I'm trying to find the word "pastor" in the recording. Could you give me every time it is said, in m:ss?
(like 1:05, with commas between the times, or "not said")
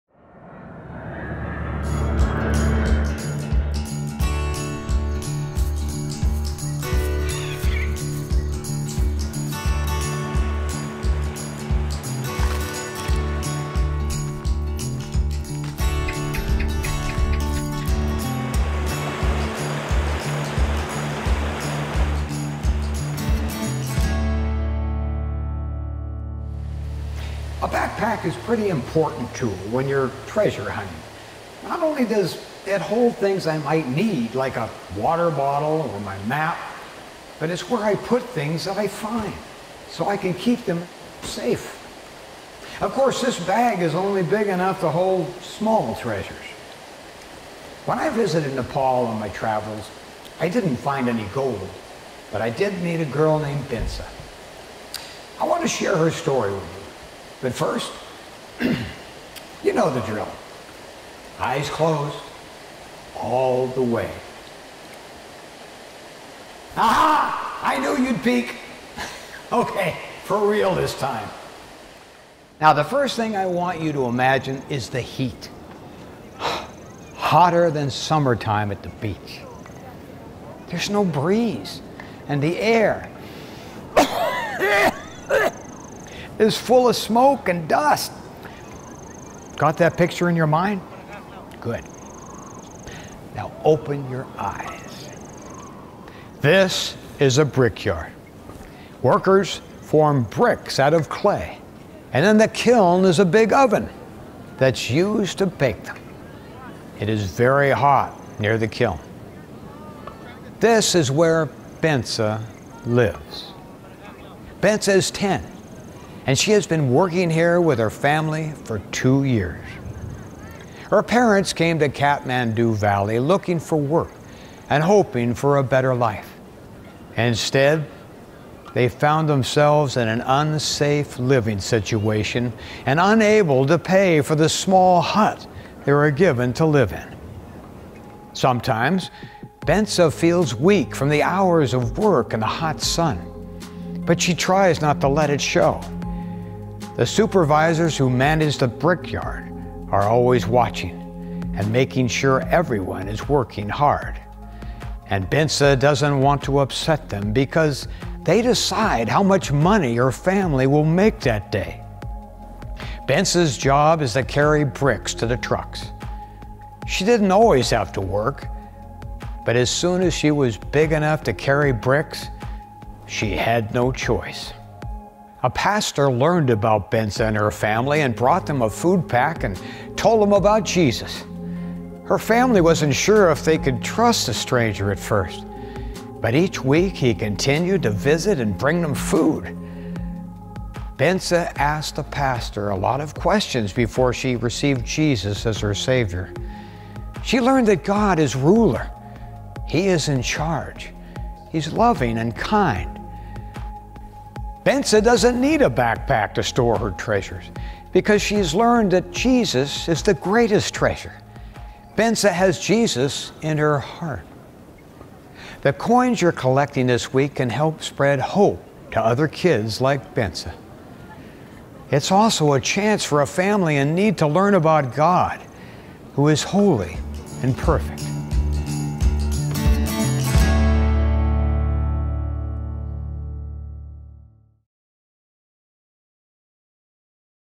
2:55, 3:12.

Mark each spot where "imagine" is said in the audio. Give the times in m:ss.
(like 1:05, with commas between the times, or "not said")
1:14.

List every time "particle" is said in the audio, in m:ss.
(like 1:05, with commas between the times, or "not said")
not said.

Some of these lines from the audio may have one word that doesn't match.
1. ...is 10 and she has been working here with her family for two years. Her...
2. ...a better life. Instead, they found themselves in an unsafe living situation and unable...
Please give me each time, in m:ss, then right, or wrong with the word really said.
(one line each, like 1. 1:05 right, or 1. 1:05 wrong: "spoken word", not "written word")
1. 1:54 right
2. 2:05 right.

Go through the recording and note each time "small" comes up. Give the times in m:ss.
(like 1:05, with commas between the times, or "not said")
0:45, 2:14.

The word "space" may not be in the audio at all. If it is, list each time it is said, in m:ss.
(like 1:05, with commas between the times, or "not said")
not said.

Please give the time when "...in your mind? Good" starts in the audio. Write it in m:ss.
1:30.